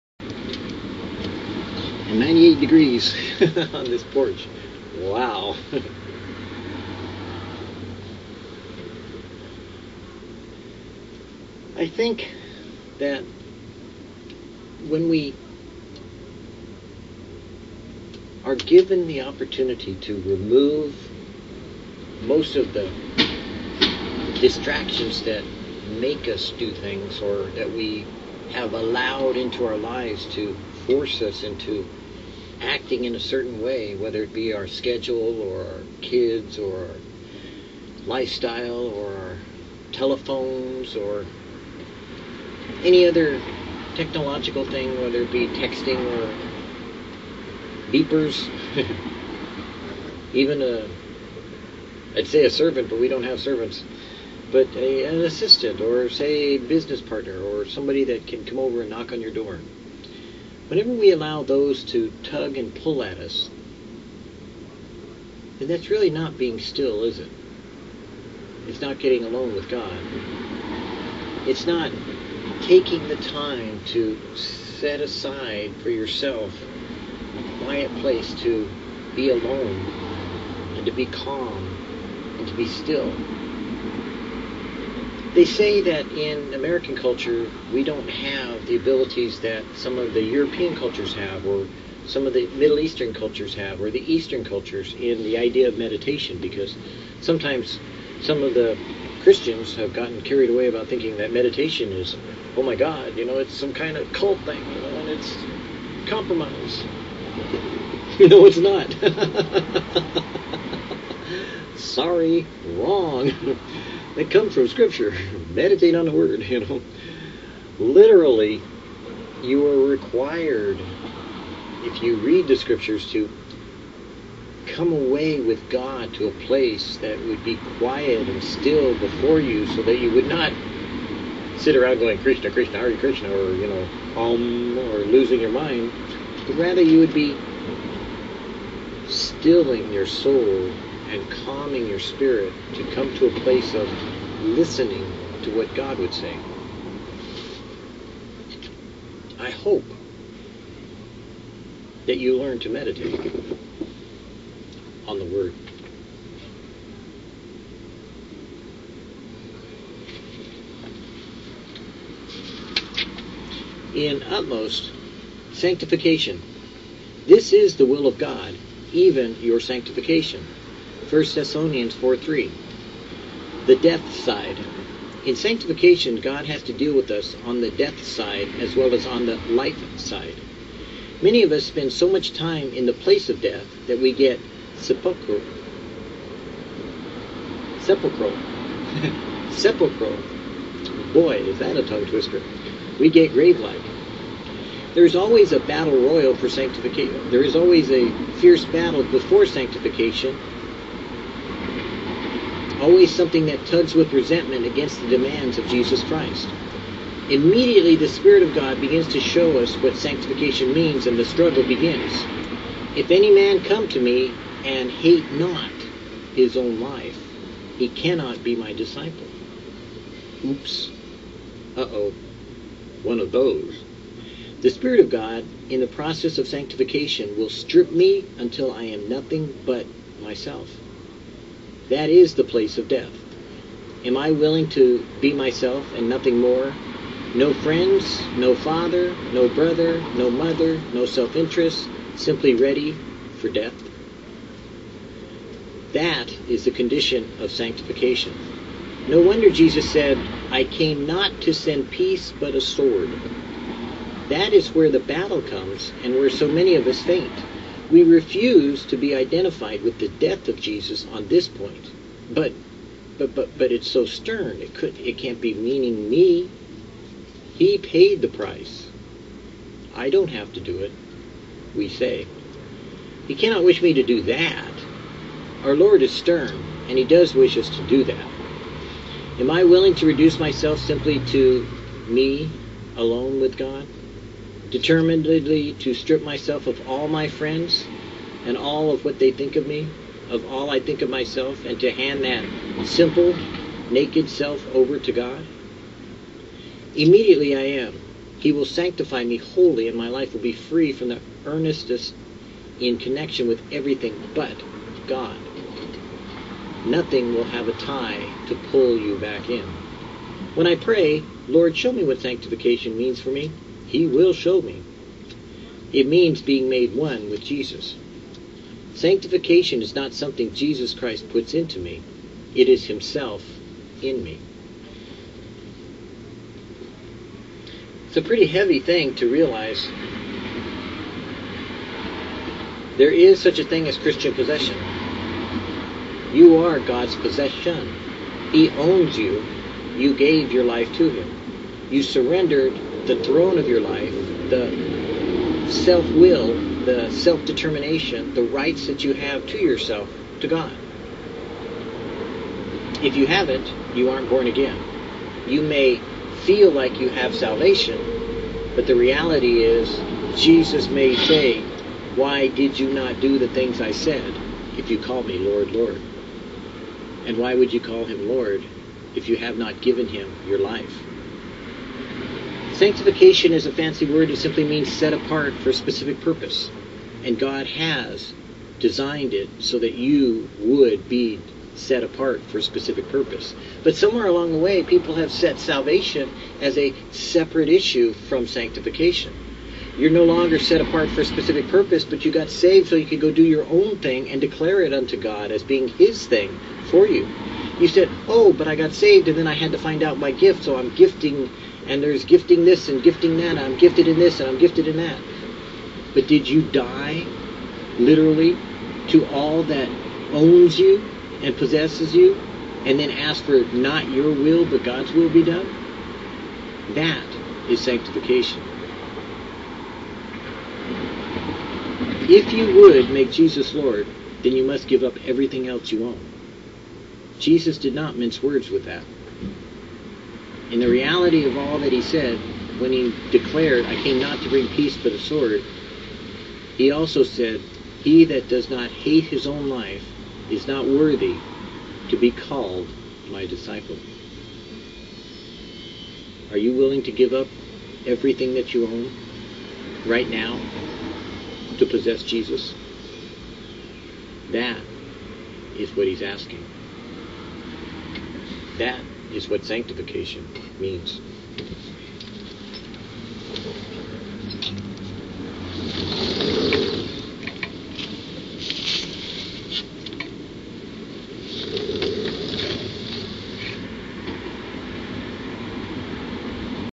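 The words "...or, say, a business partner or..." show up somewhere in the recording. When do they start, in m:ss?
0:55.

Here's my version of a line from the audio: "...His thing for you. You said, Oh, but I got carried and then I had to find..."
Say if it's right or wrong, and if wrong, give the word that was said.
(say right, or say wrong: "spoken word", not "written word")
wrong: "saved", not "carried".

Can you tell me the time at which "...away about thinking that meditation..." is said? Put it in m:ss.
1:40.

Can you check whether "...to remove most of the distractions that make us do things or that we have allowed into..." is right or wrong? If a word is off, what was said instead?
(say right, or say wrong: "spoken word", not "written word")
right.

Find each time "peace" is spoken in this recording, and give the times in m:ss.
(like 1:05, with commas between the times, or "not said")
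4:11, 7:14.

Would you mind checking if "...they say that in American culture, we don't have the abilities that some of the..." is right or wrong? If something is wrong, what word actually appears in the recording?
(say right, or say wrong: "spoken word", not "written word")
right.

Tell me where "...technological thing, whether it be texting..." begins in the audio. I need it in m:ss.
0:43.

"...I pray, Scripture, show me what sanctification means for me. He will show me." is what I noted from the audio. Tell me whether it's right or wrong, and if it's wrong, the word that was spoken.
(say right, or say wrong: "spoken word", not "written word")
wrong: "Lord", not "Scripture".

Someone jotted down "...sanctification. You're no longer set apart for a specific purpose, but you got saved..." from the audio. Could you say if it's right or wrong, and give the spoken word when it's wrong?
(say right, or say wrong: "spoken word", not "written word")
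right.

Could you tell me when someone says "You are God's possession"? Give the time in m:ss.
5:36.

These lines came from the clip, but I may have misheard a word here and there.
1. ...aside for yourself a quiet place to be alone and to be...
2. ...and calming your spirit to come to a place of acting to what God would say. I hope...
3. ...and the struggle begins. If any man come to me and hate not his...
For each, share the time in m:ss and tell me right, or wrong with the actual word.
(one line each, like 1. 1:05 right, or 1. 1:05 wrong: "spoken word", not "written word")
1. 1:14 right
2. 2:21 wrong: "listening", not "acting"
3. 3:31 right.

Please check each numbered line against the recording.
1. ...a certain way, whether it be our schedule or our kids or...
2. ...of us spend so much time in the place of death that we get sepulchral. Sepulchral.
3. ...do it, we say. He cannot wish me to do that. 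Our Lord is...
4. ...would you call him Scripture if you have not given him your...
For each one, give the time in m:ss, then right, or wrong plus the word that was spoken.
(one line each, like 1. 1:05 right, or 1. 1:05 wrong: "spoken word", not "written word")
1. 0:33 right
2. 3:01 right
3. 4:30 right
4. 6:07 wrong: "Lord", not "Scripture".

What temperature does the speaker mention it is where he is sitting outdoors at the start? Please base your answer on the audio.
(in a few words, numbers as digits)
98 degrees.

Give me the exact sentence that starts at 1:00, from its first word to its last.
Whenever we allow those to tug and pull at us, then that's really not being still, is it?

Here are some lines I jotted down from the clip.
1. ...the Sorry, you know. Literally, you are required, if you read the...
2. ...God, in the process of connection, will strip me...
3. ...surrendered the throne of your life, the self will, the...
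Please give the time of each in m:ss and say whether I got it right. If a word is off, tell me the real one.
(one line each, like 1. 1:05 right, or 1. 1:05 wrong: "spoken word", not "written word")
1. 1:56 wrong: "Word", not "Sorry"
2. 3:45 wrong: "sanctification", not "connection"
3. 5:42 right.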